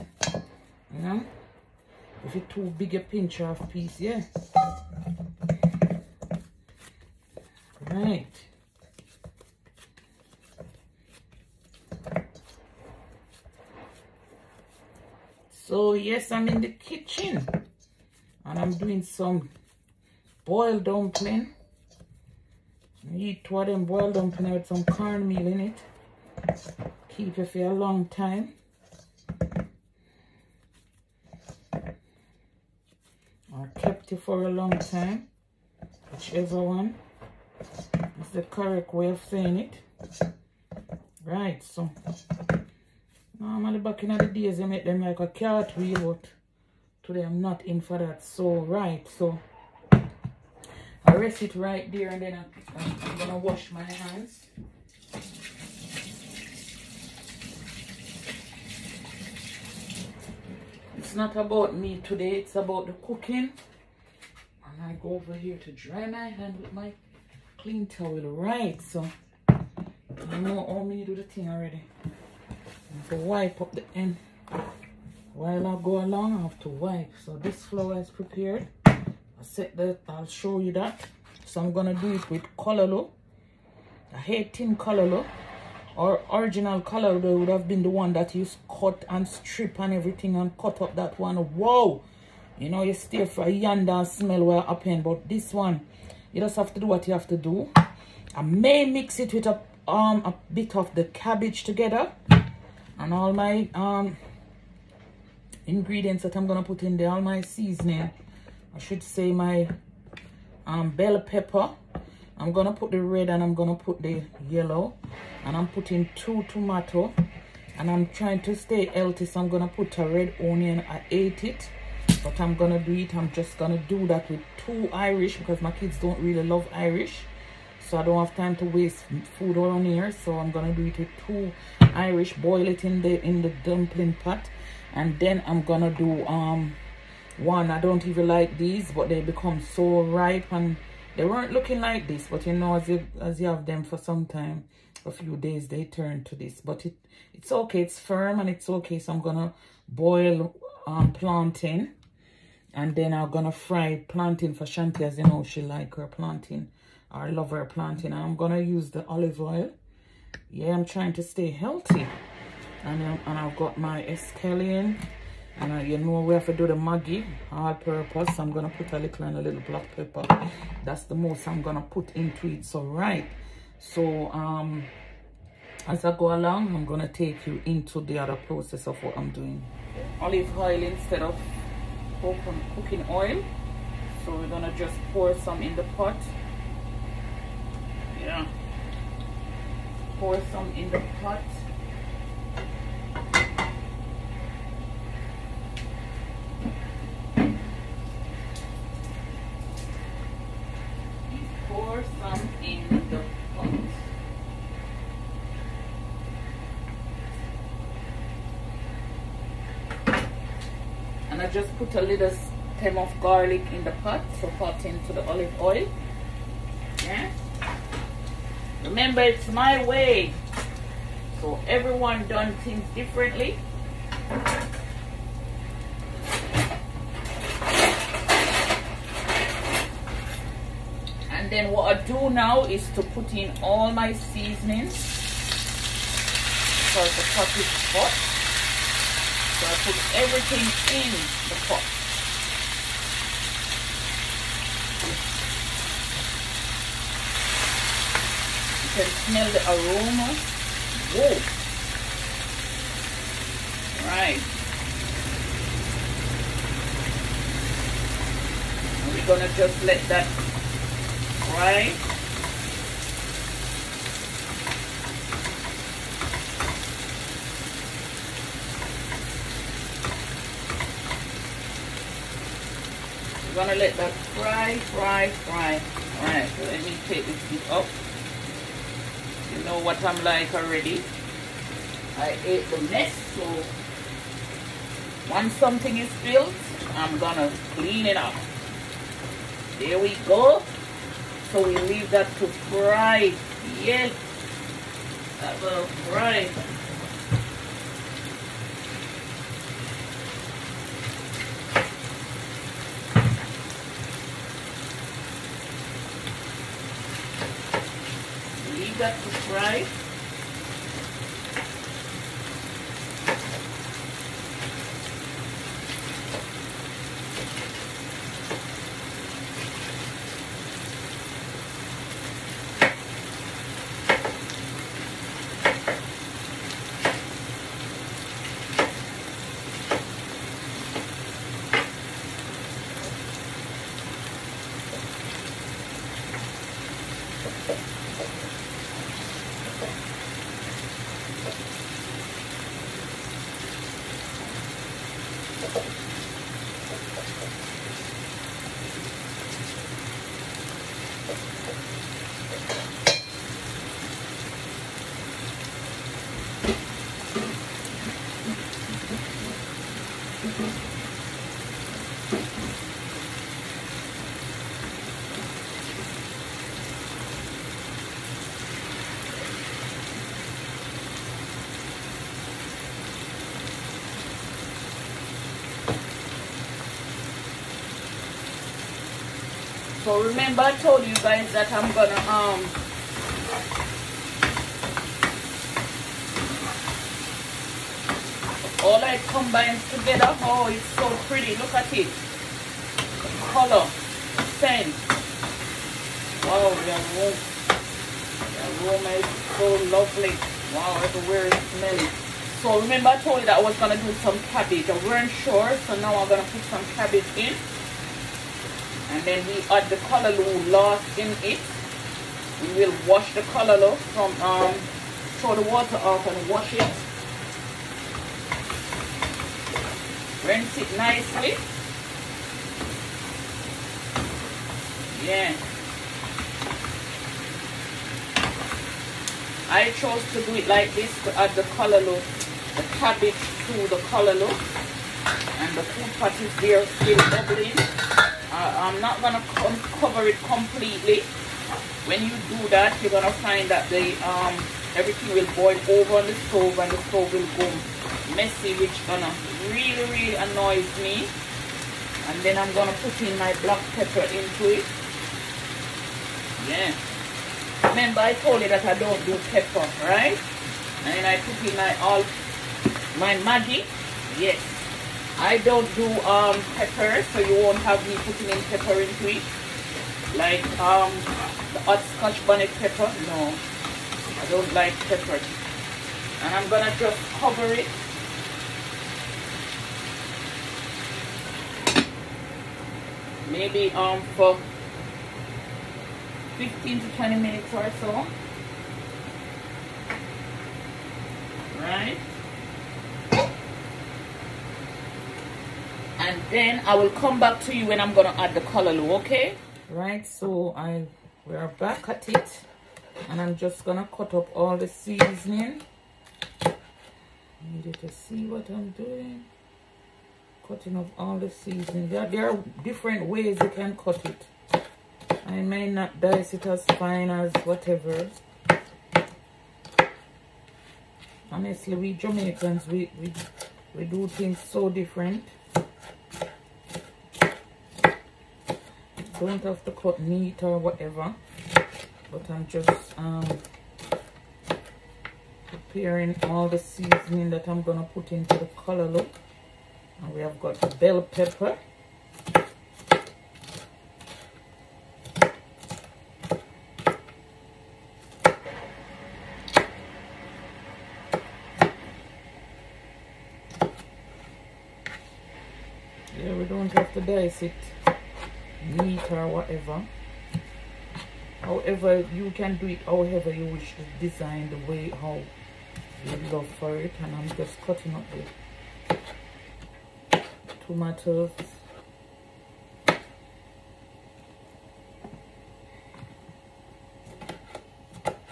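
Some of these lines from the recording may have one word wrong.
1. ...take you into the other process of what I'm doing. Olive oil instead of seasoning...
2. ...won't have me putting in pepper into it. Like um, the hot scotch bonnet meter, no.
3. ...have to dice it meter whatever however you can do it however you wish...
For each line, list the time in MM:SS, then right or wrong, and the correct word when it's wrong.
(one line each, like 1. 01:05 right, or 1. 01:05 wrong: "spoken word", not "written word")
1. 02:57 wrong: "cooking", not "seasoning"
2. 07:47 wrong: "pepper", not "meter"
3. 09:16 right.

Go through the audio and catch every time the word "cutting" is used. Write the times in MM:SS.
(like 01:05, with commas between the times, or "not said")
08:30, 09:27.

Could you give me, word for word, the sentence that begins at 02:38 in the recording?
i'm gonna use the olive oil yeah, I'm trying to stay healthy.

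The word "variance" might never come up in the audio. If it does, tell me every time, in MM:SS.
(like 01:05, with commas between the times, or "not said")
not said.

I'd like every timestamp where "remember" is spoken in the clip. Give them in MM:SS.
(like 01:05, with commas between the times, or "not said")
03:38, 06:20, 06:42, 07:37.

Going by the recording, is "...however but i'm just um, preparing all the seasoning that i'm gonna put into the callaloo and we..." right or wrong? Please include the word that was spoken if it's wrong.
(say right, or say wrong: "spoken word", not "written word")
wrong: "whatever", not "however".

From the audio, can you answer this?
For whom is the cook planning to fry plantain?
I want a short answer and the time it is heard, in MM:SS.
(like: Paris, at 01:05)
Shanti, at 02:34.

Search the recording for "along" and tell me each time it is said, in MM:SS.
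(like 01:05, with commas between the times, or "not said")
01:15, 02:56.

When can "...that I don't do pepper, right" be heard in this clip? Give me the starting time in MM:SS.
07:38.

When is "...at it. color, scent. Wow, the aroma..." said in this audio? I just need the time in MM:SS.
06:31.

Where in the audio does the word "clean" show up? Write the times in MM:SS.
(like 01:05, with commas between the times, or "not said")
01:07, 04:47.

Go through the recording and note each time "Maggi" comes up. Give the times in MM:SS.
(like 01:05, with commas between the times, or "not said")
02:46, 07:43.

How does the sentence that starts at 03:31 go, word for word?
And I just put a little stem of garlic in the pot, so pot into the olive oil.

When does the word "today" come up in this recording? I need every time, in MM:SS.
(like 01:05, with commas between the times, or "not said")
00:47, 01:02.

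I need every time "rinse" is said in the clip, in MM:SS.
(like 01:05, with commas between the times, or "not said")
07:00.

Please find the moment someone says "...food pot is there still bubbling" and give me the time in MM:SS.
07:15.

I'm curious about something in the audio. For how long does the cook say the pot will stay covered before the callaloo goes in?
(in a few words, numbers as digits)
15 to 20 minutes.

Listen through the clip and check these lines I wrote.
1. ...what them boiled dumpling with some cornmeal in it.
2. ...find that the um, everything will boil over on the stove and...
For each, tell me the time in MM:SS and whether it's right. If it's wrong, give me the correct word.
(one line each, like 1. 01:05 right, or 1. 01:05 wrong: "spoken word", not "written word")
1. 00:23 right
2. 07:23 right.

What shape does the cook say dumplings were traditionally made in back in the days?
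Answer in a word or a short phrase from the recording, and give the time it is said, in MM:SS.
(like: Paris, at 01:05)
Cartwheel, at 00:45.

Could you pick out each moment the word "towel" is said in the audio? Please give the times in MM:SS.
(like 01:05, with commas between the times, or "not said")
01:07.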